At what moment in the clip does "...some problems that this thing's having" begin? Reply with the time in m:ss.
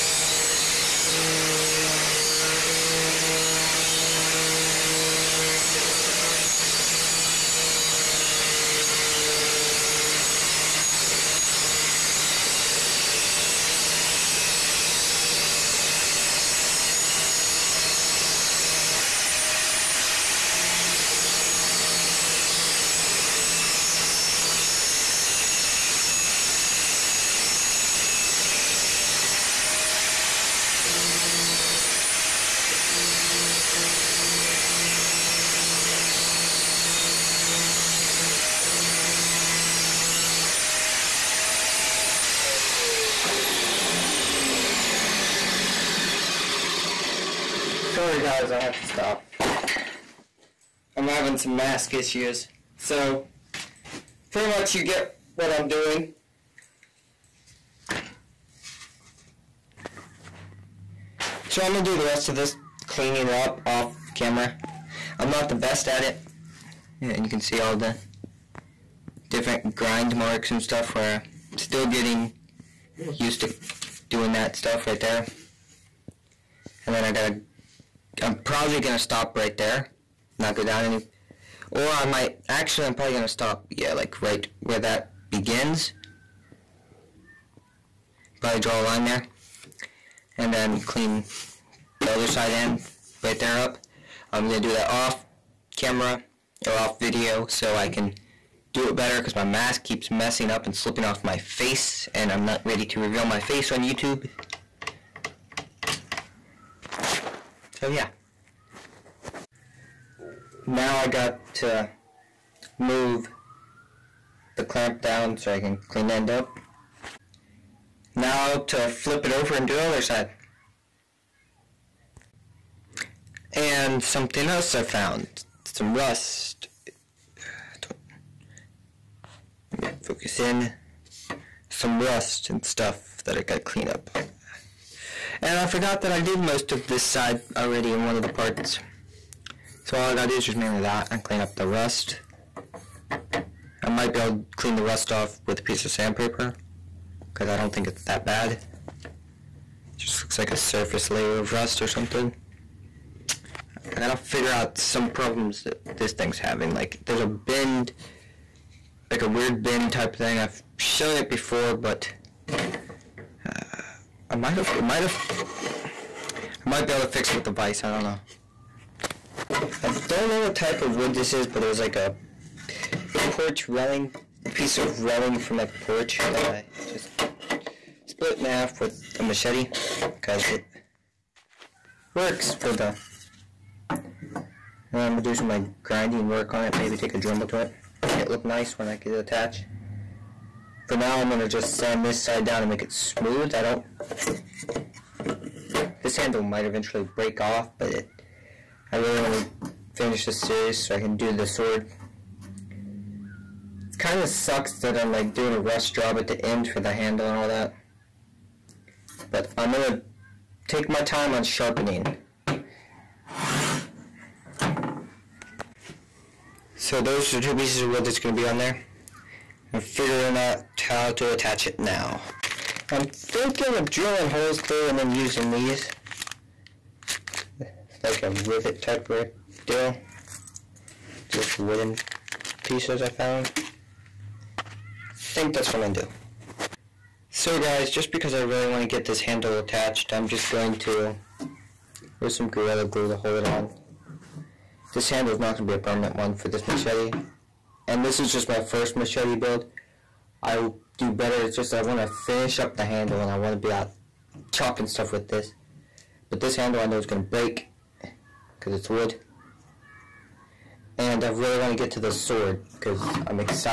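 2:34.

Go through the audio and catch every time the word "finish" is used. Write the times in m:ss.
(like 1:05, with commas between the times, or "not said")
3:19, 4:12.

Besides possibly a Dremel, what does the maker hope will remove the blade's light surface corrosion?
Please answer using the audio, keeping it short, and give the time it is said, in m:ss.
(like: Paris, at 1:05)
Sandpaper, at 2:25.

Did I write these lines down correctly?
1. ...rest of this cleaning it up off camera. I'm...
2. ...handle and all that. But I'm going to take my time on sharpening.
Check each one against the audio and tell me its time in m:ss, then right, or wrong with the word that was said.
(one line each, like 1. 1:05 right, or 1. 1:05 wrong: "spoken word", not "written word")
1. 1:02 right
2. 3:26 right.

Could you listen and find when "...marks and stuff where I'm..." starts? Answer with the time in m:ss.
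1:10.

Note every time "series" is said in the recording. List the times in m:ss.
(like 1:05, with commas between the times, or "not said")
3:20.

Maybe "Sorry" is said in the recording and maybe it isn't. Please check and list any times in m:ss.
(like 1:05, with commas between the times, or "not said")
0:47.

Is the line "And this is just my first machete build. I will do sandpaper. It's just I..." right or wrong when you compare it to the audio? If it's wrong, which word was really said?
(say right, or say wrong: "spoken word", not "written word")
wrong: "better", not "sandpaper".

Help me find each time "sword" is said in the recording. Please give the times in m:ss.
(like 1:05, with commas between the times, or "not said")
3:21, 4:22.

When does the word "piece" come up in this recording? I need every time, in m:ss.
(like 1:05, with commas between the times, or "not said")
2:25, 2:54, 3:37, 3:52.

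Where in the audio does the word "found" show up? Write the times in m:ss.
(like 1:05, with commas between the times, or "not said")
2:04, 3:53.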